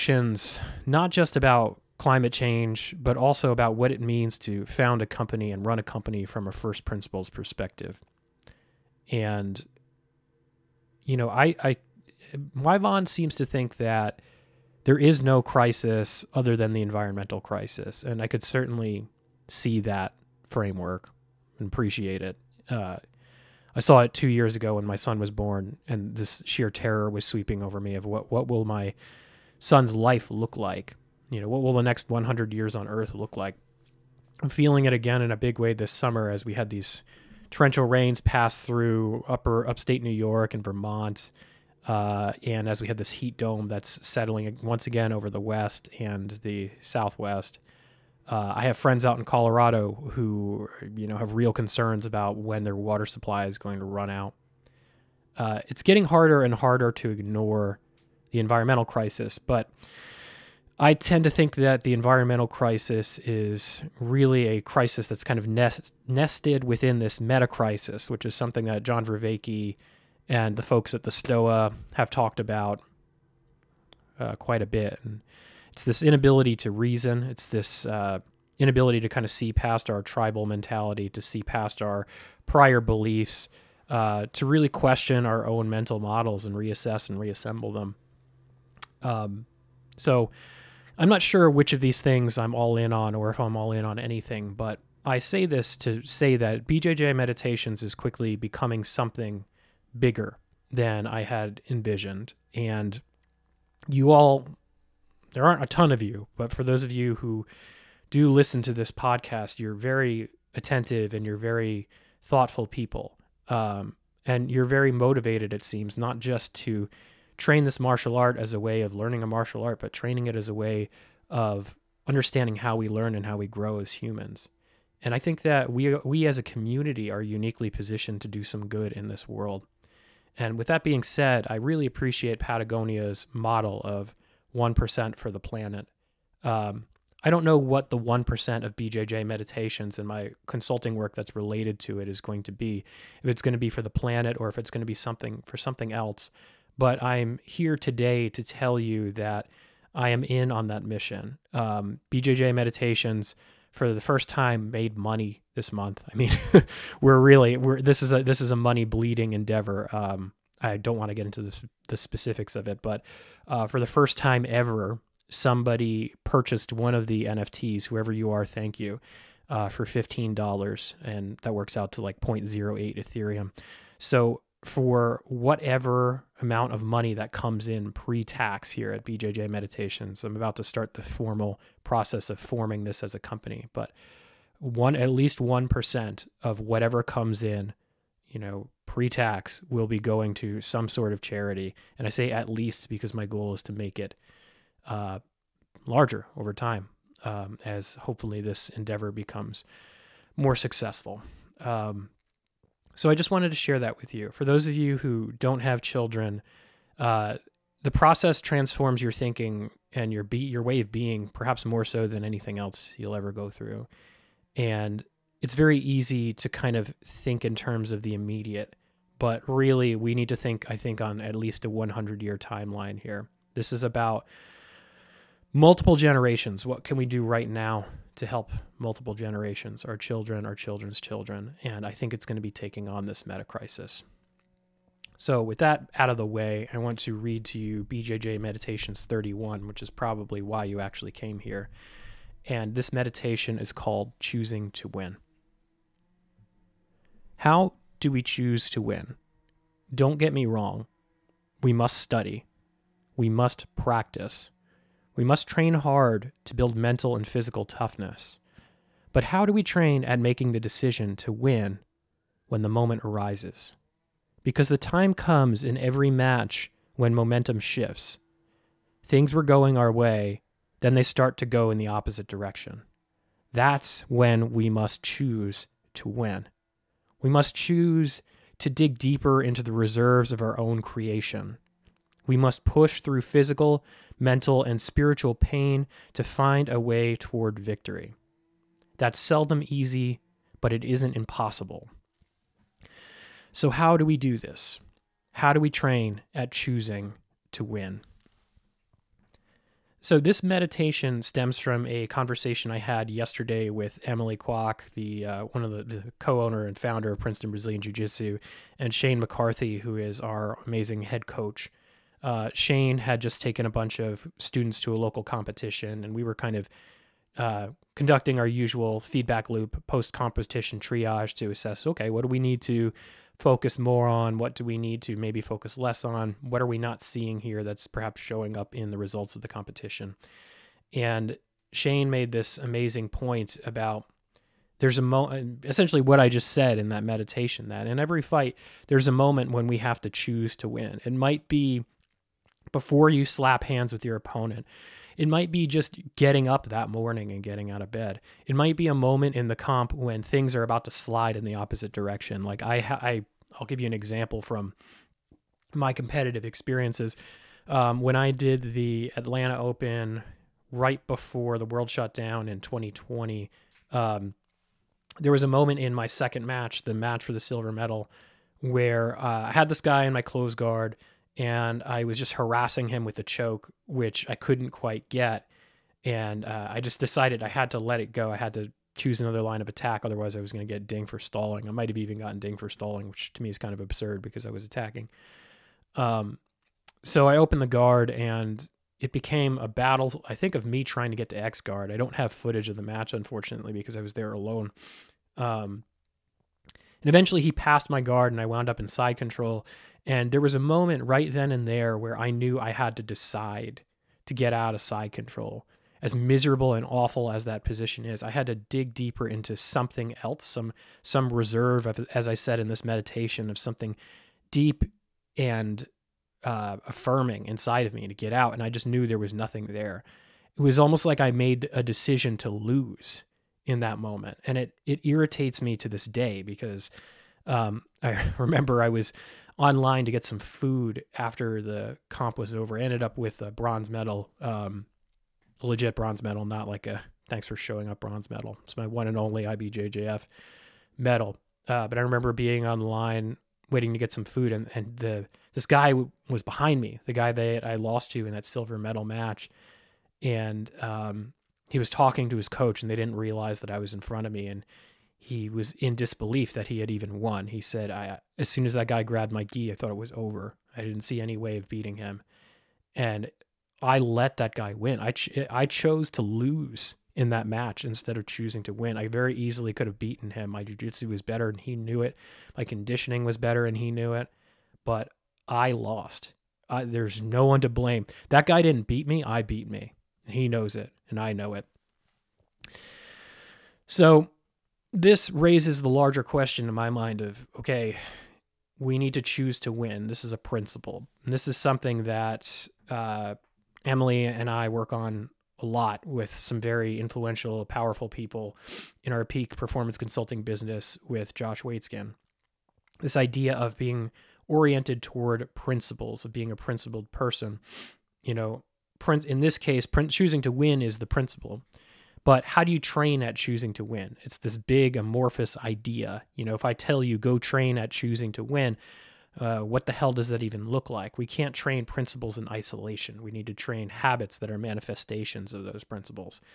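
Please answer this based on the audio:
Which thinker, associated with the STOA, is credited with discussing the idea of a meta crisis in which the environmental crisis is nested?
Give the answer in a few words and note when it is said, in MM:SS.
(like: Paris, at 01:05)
John Vervaeke, at 01:08.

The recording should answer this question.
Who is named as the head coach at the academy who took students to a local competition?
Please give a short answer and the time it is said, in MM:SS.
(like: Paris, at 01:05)
Shane McCarthy, at 05:08.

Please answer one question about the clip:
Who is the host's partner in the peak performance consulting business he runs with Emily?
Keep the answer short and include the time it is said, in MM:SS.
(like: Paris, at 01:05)
Josh Waitzkin, at 08:21.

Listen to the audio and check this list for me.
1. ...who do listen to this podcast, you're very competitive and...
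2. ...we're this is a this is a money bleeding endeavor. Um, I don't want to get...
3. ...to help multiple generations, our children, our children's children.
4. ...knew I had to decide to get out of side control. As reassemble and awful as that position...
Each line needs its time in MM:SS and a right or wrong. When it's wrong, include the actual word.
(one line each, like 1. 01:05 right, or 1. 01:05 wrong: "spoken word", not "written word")
1. 01:47 wrong: "attentive", not "competitive"
2. 02:37 right
3. 03:48 right
4. 06:42 wrong: "miserable", not "reassemble".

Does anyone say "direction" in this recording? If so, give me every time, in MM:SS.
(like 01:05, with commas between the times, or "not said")
04:32, 05:51.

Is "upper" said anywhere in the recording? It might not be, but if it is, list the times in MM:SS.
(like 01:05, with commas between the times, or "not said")
00:39.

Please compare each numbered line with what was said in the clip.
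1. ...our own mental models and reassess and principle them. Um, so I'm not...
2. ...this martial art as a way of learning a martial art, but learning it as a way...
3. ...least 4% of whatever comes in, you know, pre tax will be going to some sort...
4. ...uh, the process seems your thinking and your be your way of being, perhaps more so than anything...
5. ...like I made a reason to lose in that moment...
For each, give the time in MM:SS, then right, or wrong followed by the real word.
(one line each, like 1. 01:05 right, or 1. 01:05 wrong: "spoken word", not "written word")
1. 01:25 wrong: "reassemble", not "principle"
2. 01:57 wrong: "training", not "learning"
3. 03:05 wrong: "1", not "4"
4. 03:26 wrong: "transforms", not "seems"
5. 07:01 wrong: "decision", not "reason".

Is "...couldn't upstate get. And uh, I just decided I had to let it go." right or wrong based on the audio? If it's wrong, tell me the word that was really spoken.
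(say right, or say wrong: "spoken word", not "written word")
wrong: "quite", not "upstate".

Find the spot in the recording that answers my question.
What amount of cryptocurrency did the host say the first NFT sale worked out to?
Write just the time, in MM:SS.
02:52.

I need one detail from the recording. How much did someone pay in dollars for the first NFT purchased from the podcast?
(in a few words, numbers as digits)
$15.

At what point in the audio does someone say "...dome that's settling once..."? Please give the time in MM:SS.
00:43.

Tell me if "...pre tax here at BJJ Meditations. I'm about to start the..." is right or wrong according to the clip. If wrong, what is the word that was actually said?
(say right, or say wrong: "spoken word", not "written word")
right.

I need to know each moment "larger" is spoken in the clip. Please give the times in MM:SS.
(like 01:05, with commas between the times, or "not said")
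03:15, 08:05.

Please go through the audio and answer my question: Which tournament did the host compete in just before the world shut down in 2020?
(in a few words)
Atlanta Open.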